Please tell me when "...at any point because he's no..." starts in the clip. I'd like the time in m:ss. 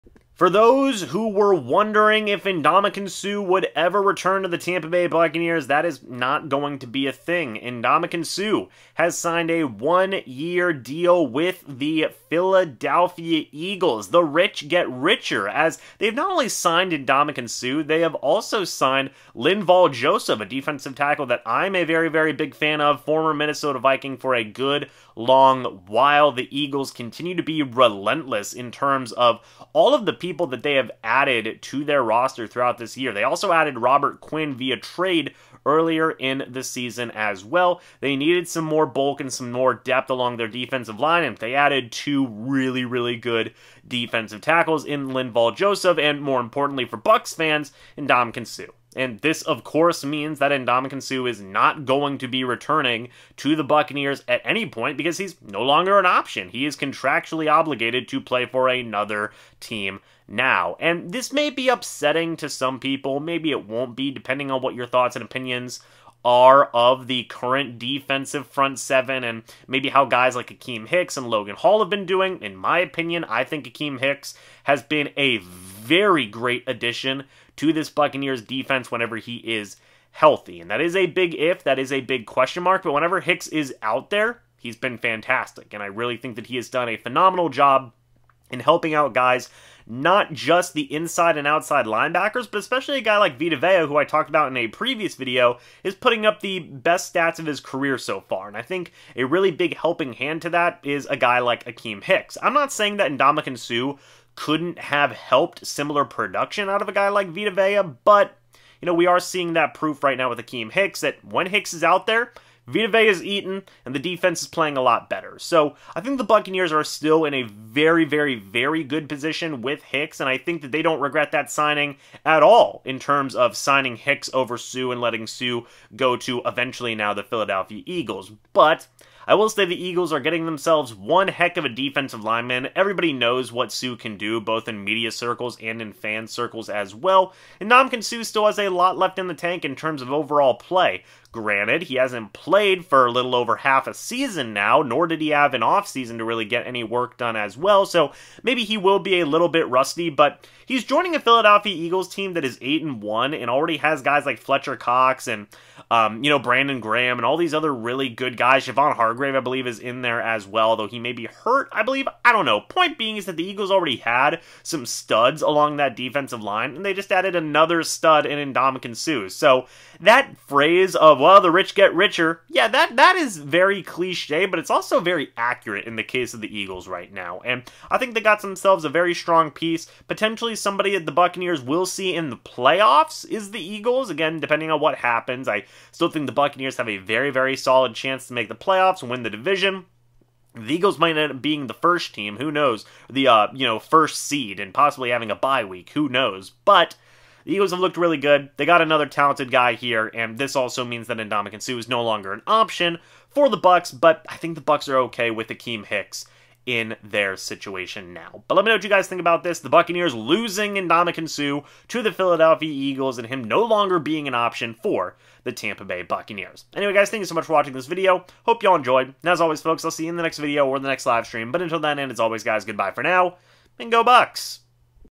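0:54.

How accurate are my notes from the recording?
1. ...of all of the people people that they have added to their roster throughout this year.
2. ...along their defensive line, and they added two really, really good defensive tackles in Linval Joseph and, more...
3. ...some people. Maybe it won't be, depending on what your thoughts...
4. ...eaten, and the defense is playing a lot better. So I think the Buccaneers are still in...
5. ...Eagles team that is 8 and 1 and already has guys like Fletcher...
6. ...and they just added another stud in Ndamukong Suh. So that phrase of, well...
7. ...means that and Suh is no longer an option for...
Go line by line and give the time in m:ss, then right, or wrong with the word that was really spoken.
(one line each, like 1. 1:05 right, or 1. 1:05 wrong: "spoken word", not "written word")
1. 0:29 right
2. 0:40 right
3. 1:02 right
4. 1:53 right
5. 2:31 right
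6. 2:46 right
7. 3:20 right.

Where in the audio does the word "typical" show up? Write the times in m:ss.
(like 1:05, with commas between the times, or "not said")
not said.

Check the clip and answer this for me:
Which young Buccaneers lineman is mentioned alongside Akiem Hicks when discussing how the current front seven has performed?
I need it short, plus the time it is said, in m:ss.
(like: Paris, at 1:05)
Logan Hall, at 1:11.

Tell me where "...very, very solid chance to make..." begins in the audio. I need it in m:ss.
3:06.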